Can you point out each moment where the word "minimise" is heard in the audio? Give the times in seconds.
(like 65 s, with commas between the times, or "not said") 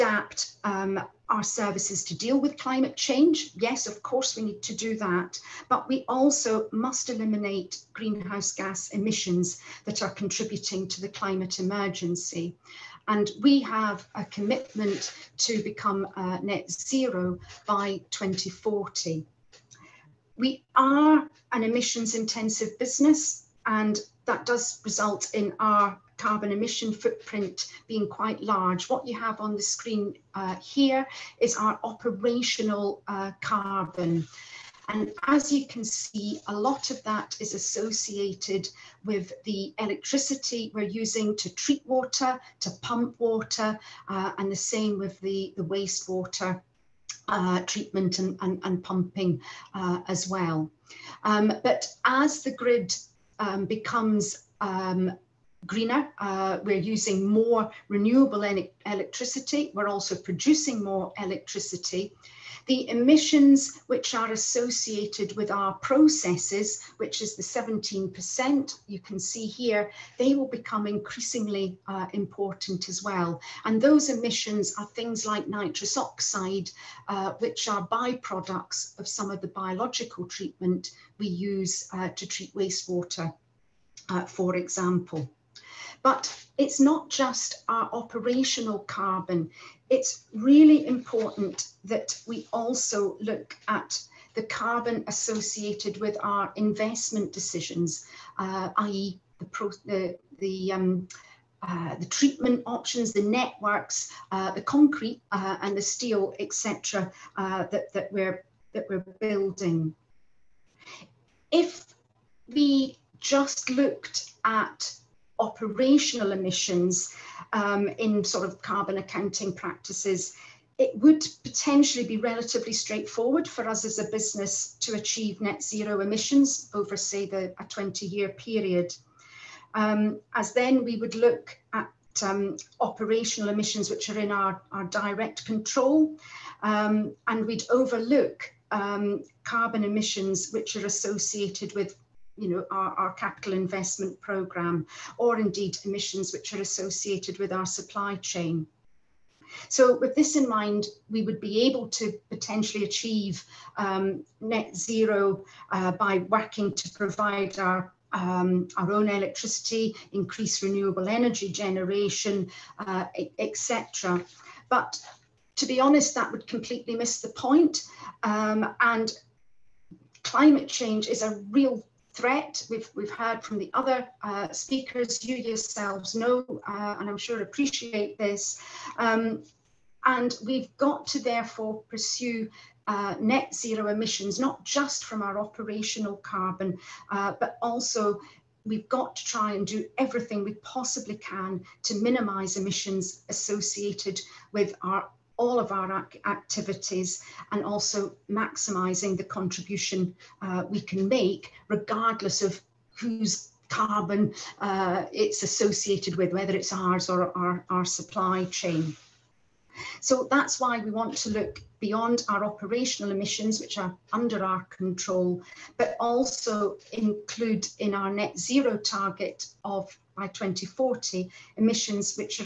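192 s.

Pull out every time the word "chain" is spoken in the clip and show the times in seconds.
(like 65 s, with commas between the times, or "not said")
148 s, 208 s.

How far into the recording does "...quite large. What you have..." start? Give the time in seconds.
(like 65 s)
28 s.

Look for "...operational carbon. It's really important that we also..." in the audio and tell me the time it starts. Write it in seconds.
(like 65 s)
87 s.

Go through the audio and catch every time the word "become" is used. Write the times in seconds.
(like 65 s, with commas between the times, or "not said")
15 s, 53 s, 70 s.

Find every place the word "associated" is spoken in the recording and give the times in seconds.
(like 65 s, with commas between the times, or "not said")
37 s, 64 s, 95 s, 140 s, 146 s, 193 s, 205 s.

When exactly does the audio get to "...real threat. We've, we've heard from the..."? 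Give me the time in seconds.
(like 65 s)
171 s.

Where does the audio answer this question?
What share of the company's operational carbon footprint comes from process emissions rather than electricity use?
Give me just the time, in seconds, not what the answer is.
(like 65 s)
67 s.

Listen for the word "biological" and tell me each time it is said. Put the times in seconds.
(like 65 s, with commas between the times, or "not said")
79 s.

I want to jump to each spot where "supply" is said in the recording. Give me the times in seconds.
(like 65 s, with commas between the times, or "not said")
147 s, 207 s.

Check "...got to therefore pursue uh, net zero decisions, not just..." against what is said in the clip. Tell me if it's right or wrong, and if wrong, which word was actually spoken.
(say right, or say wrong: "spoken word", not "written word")
wrong: "emissions", not "decisions".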